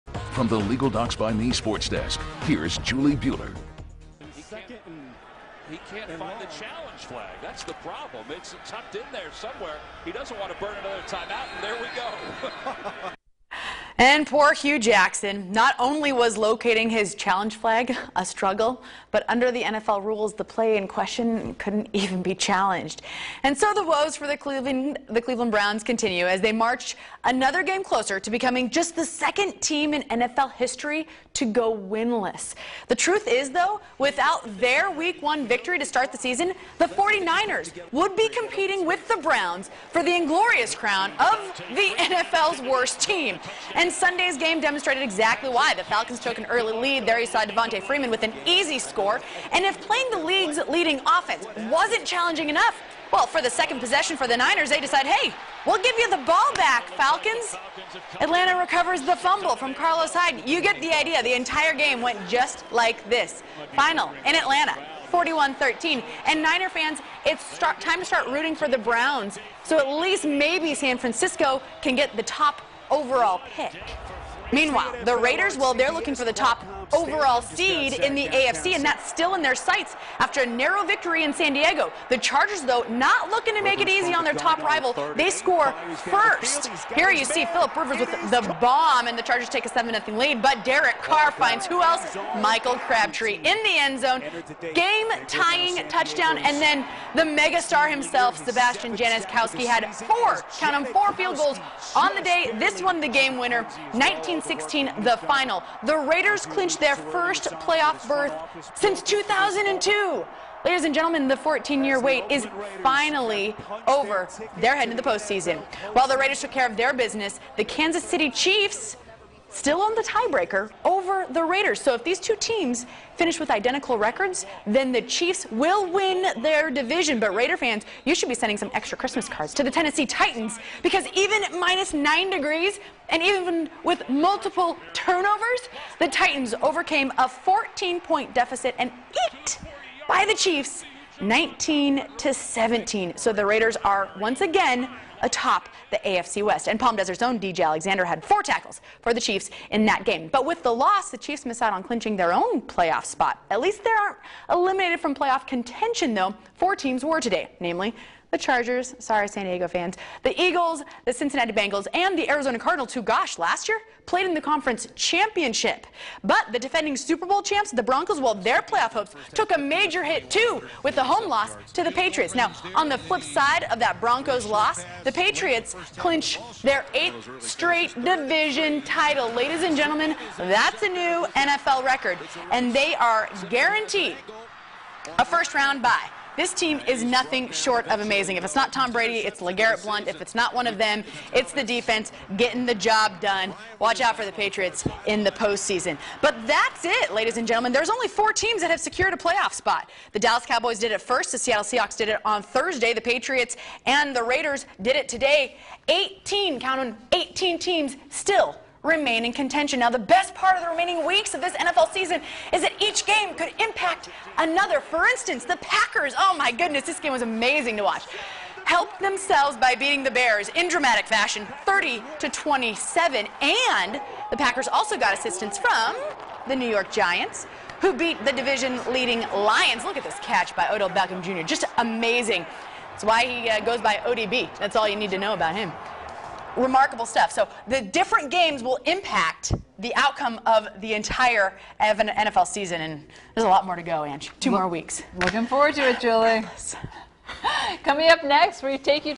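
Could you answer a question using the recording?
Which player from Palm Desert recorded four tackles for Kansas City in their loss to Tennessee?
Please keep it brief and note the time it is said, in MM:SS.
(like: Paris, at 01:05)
DJ Alexander, at 02:27.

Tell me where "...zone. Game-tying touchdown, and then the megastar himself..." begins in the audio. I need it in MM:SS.
01:33.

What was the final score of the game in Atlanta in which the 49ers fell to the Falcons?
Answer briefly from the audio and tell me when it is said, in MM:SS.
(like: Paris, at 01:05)
41-13, at 01:05.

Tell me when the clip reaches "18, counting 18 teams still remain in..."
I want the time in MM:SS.
03:25.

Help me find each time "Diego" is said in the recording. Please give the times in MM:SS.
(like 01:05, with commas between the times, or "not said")
01:21, 02:39.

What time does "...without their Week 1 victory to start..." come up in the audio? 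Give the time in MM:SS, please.
00:33.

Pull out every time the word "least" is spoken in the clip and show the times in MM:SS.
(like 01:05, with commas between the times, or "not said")
01:10, 02:33.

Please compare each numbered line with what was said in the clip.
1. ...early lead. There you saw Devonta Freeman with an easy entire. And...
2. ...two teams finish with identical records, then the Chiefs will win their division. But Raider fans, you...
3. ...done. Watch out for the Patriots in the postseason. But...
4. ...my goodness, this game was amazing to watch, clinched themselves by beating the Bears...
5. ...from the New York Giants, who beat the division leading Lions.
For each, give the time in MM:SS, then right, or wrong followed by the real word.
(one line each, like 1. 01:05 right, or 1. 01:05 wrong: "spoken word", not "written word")
1. 00:46 wrong: "score", not "entire"
2. 02:02 right
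3. 03:13 right
4. 03:36 wrong: "helped", not "clinched"
5. 03:45 right.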